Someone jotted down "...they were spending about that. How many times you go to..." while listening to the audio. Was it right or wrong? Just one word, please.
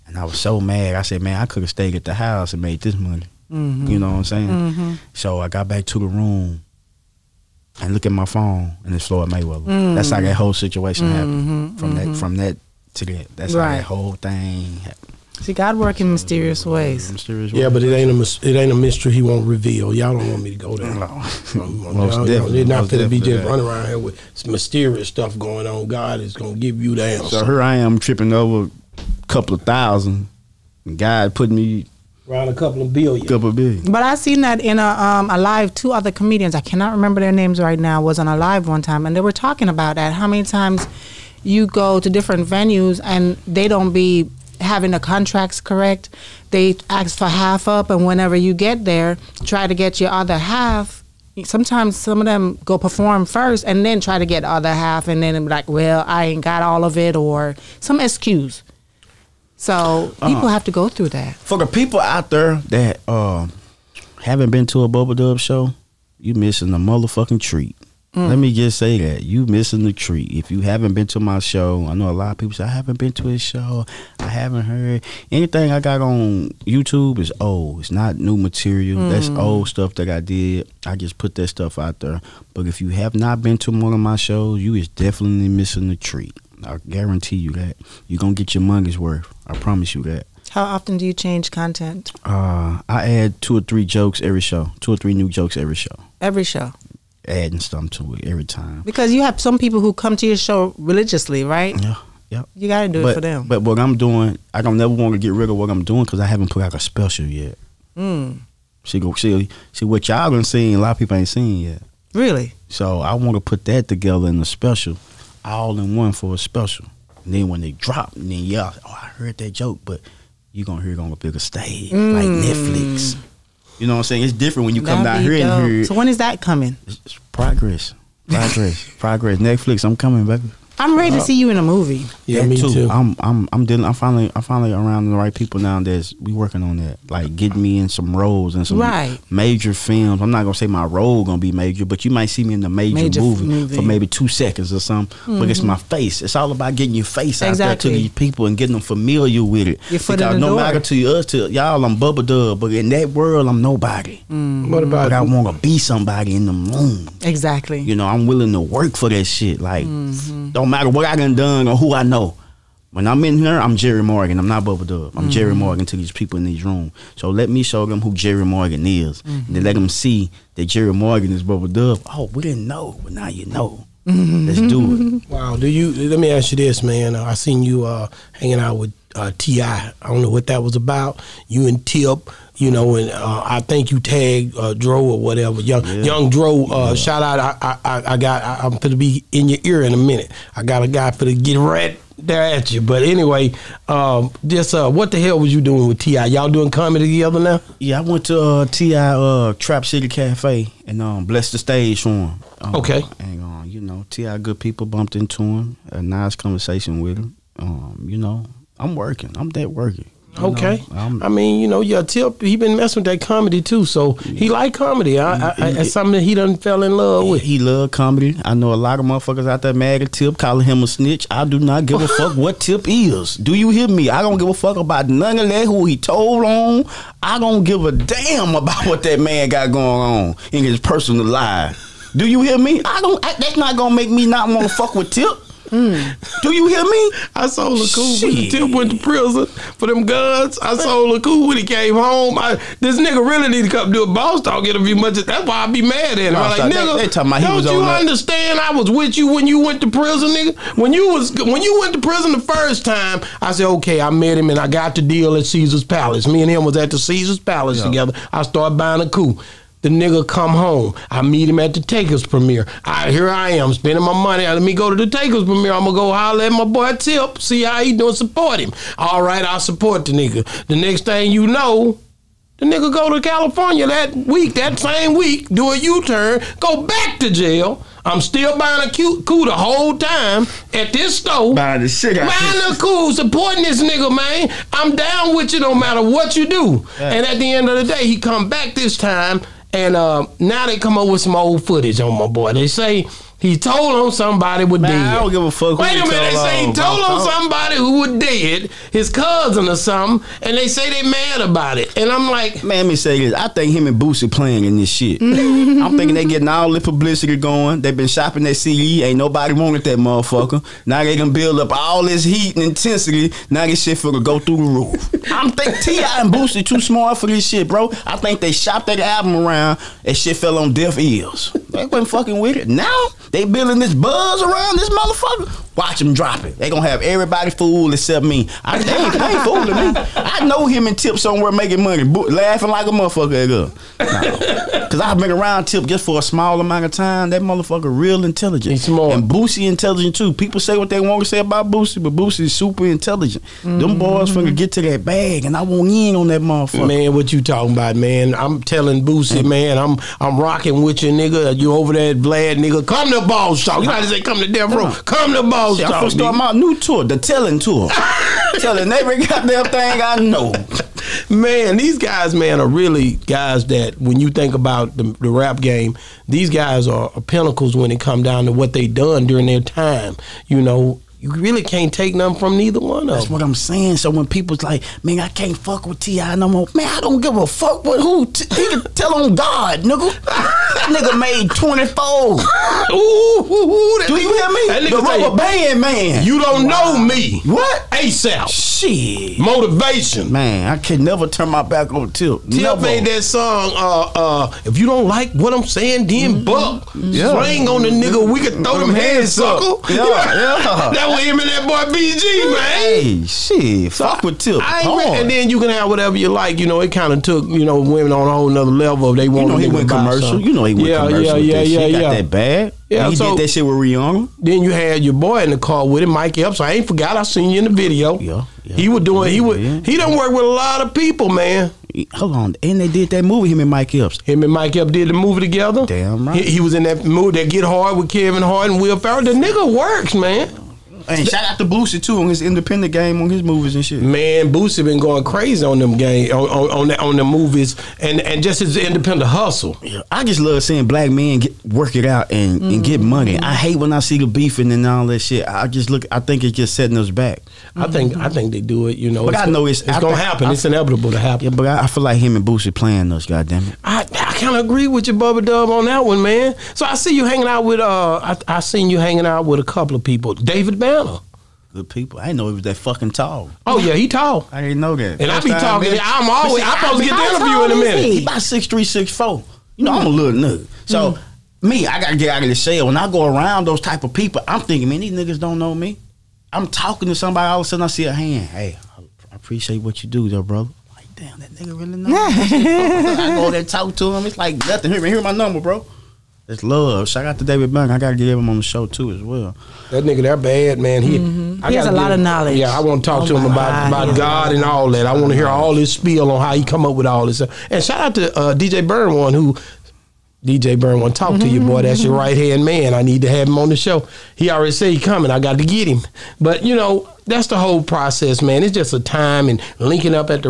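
wrong.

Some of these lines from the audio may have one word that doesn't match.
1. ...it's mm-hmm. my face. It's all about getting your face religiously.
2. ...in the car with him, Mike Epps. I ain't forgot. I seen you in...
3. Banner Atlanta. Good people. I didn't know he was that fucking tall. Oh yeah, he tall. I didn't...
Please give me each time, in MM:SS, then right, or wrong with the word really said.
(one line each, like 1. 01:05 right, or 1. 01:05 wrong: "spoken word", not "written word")
1. 02:25 wrong: "exactly", not "religiously"
2. 06:55 right
3. 07:40 right.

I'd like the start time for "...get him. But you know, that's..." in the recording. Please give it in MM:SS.
08:25.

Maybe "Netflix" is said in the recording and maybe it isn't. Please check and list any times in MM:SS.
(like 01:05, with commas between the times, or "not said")
02:02, 02:09.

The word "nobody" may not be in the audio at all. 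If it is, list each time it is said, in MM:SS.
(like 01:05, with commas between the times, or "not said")
02:33, 05:09.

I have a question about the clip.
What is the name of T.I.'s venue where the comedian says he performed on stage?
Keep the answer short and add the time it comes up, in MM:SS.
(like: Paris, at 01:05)
Trap City Cafe, at 03:19.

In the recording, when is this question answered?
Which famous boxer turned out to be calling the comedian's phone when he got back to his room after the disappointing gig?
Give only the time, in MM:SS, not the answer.
00:09.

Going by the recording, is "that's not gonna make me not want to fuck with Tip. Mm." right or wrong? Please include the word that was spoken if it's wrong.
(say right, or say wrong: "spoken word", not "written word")
right.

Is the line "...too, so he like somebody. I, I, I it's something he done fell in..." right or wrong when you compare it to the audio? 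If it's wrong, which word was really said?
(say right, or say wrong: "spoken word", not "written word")
wrong: "comedy", not "somebody".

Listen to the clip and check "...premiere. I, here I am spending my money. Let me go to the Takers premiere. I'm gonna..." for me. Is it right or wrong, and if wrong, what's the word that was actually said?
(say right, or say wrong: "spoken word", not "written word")
right.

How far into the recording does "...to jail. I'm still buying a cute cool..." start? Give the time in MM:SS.
04:37.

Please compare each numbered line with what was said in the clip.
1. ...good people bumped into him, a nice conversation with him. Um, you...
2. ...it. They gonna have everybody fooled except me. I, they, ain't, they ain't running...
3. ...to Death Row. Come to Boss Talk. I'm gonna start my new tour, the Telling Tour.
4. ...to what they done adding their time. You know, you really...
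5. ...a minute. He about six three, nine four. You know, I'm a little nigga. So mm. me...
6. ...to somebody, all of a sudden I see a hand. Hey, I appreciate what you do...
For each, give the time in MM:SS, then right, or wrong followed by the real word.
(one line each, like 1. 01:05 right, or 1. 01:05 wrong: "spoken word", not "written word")
1. 03:24 right
2. 05:26 wrong: "fooling", not "running"
3. 05:54 right
4. 06:08 wrong: "during", not "adding"
5. 07:47 wrong: "six", not "nine"
6. 07:57 right.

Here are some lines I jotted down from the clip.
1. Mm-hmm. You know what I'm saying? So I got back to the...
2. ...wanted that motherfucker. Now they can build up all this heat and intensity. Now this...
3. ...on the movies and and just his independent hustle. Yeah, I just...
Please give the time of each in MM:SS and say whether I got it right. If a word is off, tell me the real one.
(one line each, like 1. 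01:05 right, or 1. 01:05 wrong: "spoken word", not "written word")
1. 00:03 right
2. 05:09 right
3. 07:16 right.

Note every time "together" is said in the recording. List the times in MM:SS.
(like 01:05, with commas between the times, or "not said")
01:53, 03:17, 04:17, 07:05.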